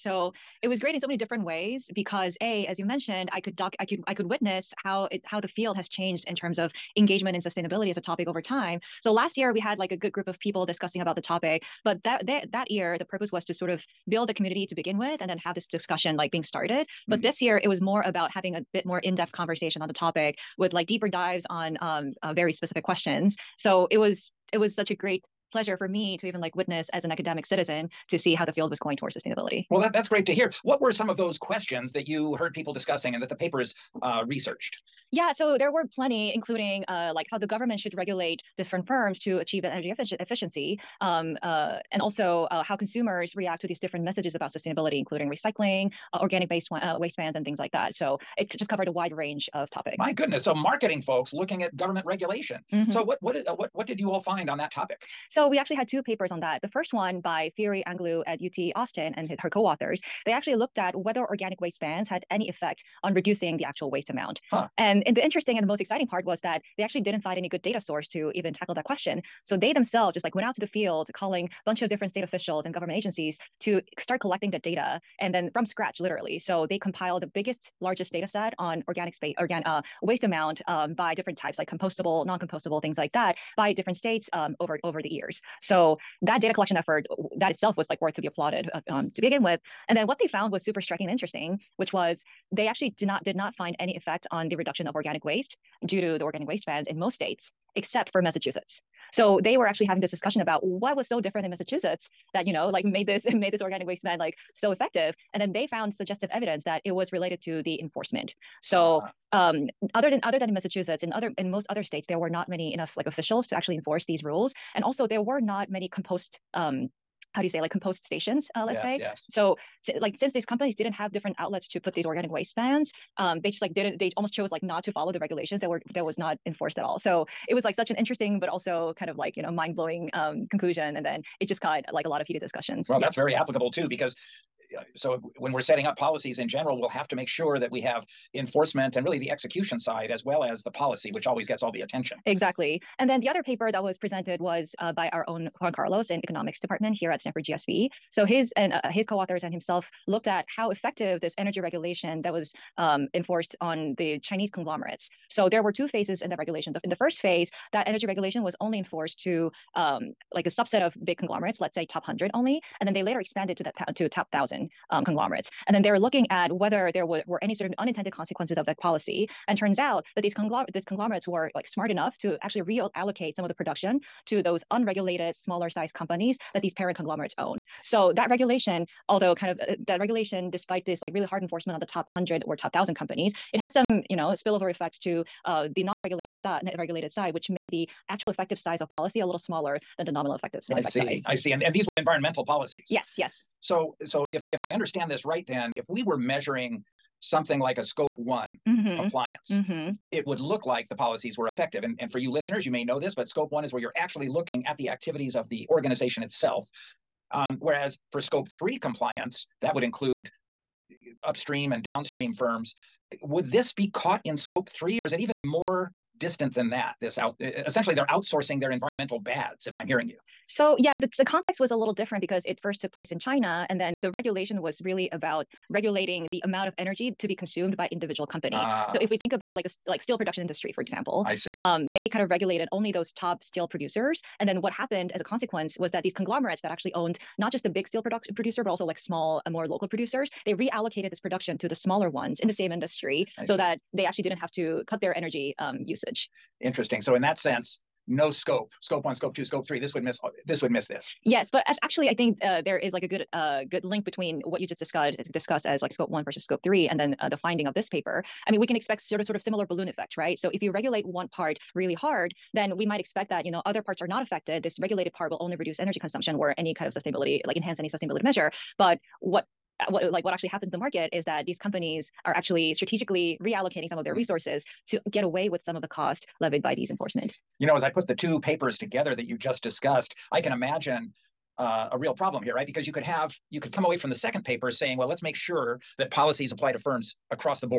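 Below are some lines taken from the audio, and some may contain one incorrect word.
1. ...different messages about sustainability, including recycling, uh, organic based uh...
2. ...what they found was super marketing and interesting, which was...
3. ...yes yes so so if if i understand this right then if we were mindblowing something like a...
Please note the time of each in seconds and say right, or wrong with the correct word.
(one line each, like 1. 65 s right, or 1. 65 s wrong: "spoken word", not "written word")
1. 43 s right
2. 90 s wrong: "striking", not "marketing"
3. 192 s wrong: "measuring", not "mindblowing".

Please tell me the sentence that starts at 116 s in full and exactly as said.
Um, how do you say like compost stations?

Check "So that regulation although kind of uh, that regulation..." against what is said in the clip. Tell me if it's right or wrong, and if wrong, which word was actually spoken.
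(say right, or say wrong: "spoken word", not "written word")
right.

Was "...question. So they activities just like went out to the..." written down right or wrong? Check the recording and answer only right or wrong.
wrong.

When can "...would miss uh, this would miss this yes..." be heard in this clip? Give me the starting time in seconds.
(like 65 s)
249 s.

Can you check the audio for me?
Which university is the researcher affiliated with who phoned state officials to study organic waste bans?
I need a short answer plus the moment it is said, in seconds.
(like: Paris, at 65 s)
UT Austin, at 58 s.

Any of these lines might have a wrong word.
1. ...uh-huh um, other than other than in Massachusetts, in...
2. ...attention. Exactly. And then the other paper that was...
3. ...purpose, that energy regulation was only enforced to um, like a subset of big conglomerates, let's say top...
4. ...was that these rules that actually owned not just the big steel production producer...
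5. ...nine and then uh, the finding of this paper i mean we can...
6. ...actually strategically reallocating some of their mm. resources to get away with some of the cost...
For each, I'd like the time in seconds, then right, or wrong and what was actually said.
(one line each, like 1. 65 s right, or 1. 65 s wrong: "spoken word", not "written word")
1. 109 s right
2. 141 s right
3. 157 s wrong: "phase", not "purpose"
4. 235 s wrong: "conglomerates", not "rules"
5. 256 s wrong: "three", not "nine"
6. 272 s right.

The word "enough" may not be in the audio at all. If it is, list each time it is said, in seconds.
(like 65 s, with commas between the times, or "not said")
112 s, 171 s.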